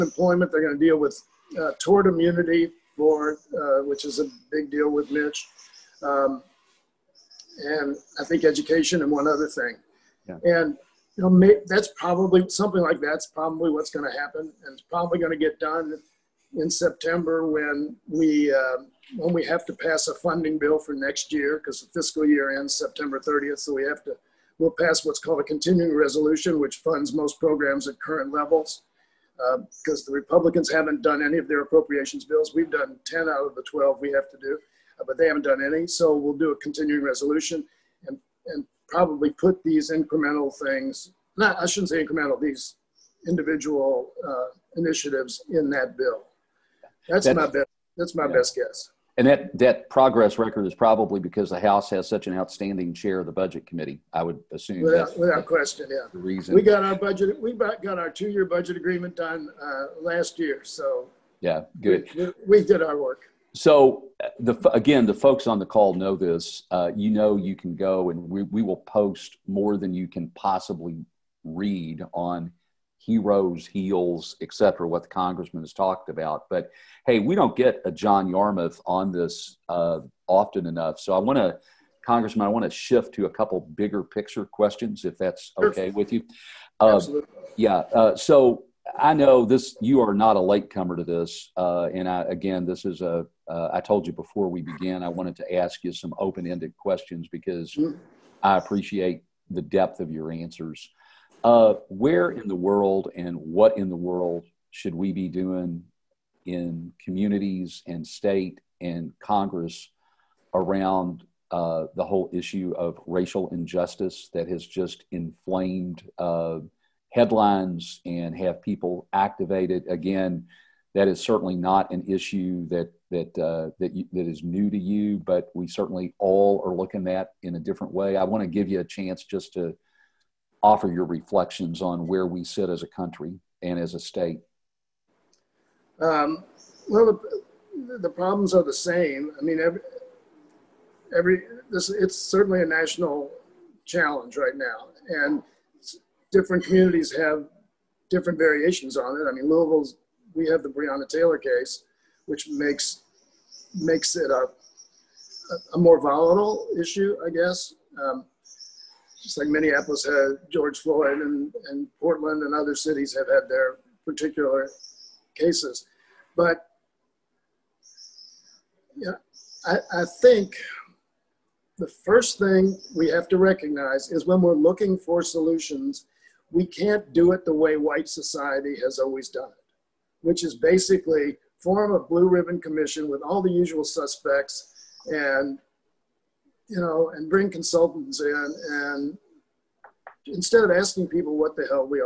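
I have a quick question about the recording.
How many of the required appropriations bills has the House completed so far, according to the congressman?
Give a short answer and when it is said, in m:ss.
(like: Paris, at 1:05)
10, at 0:33.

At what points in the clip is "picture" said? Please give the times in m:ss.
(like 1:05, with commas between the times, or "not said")
1:24.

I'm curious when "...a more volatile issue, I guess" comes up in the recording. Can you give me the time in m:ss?
2:35.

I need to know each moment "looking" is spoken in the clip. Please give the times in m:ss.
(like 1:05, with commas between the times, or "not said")
2:06, 2:54.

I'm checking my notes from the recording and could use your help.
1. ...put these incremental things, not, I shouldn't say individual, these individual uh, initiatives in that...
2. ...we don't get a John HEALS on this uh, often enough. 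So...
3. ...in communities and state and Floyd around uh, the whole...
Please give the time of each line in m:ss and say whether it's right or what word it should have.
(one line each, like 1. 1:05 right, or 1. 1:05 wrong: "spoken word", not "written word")
1. 0:39 wrong: "incremental", not "individual"
2. 1:17 wrong: "Yarmuth", not "HEALS"
3. 1:46 wrong: "Congress", not "Floyd".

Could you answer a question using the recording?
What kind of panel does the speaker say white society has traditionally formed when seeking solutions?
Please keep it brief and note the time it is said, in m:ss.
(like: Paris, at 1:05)
blue ribbon commission, at 3:01.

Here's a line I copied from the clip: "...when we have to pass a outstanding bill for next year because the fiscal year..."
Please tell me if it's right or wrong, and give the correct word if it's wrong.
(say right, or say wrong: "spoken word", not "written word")
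wrong: "funding", not "outstanding".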